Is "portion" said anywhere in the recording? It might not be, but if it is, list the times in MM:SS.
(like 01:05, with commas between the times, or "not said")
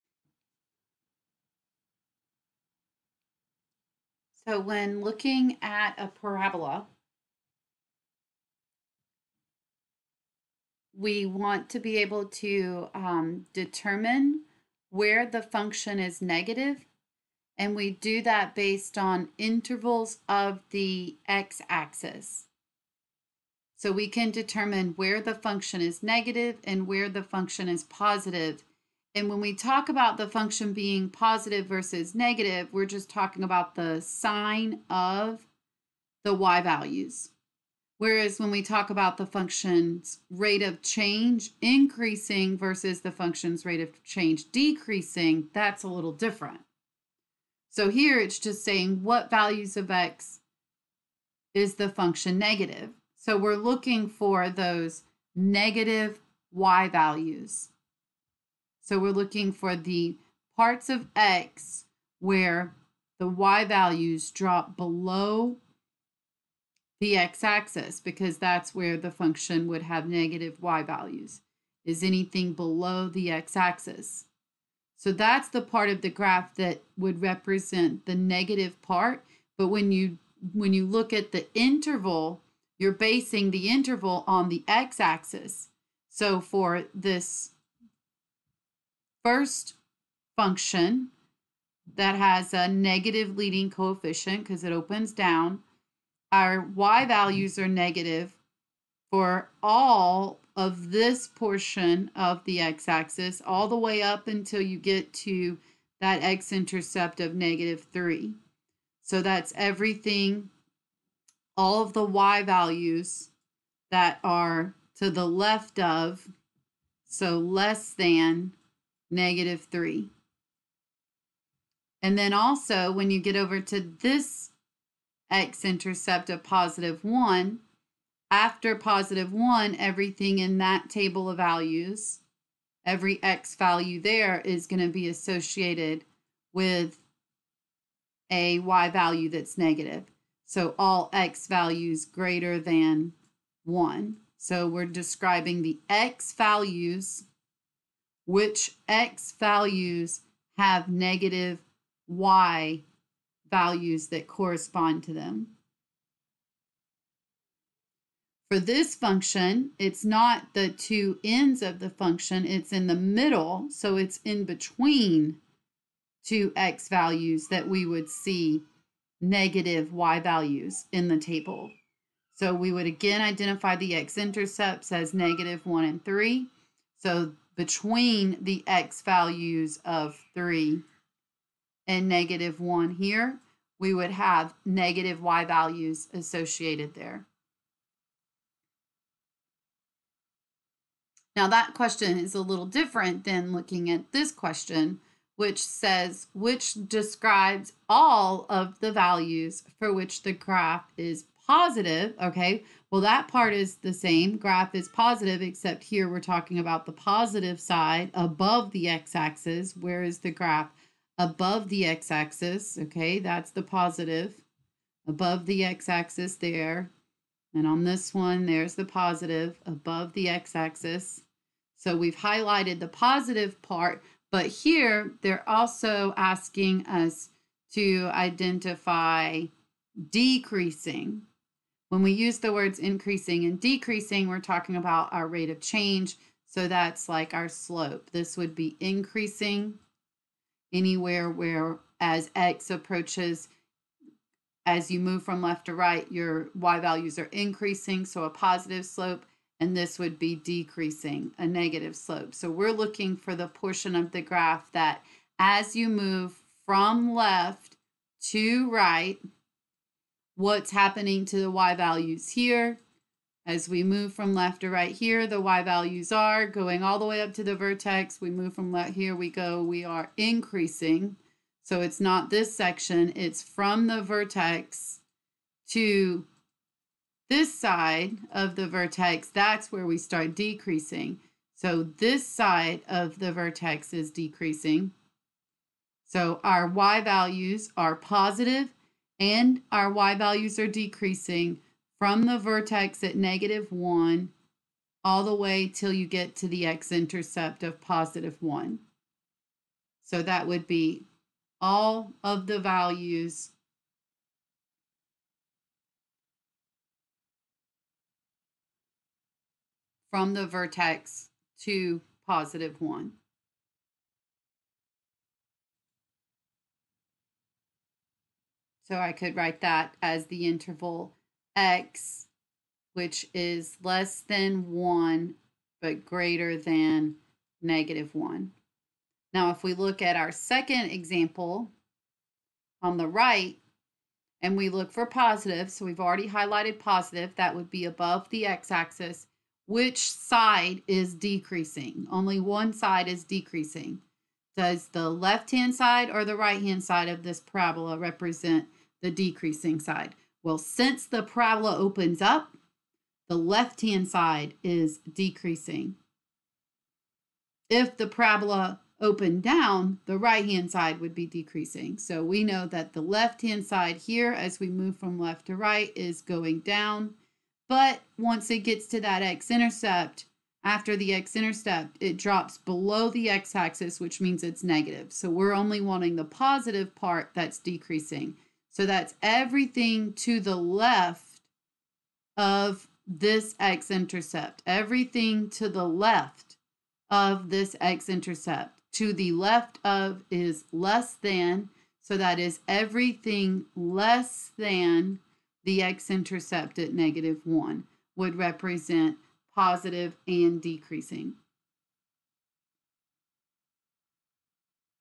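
01:41, 04:13.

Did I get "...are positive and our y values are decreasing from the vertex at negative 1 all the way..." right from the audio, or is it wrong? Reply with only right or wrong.
right.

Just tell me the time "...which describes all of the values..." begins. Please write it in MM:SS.
03:16.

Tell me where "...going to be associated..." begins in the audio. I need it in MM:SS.
02:14.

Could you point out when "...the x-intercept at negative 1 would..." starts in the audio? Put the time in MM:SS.
06:35.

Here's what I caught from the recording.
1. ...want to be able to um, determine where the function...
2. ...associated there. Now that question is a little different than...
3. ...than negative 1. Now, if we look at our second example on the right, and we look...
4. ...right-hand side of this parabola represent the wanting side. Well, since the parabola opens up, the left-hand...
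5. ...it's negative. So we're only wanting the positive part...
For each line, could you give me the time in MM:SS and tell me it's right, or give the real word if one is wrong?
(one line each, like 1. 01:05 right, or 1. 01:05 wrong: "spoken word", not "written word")
1. 00:11 right
2. 03:06 right
3. 05:26 right
4. 05:46 wrong: "decreasing", not "wanting"
5. 06:14 right.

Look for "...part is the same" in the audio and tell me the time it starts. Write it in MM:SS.
03:23.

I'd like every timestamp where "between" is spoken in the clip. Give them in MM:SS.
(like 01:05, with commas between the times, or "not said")
02:44, 02:57.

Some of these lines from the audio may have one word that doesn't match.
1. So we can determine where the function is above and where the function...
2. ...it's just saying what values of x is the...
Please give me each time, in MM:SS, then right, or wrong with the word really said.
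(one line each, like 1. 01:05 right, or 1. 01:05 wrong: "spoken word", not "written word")
1. 00:23 wrong: "negative", not "above"
2. 00:48 right.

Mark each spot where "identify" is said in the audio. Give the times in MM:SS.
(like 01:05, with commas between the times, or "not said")
02:53, 03:48.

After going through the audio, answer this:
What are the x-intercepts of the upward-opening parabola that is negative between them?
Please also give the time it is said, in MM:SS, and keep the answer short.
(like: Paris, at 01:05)
-1 and 3, at 02:55.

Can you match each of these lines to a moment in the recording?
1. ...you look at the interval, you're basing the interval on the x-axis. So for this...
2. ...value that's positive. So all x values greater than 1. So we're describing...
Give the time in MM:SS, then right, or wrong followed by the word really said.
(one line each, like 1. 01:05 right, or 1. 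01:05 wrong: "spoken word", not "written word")
1. 01:20 right
2. 02:18 wrong: "negative", not "positive".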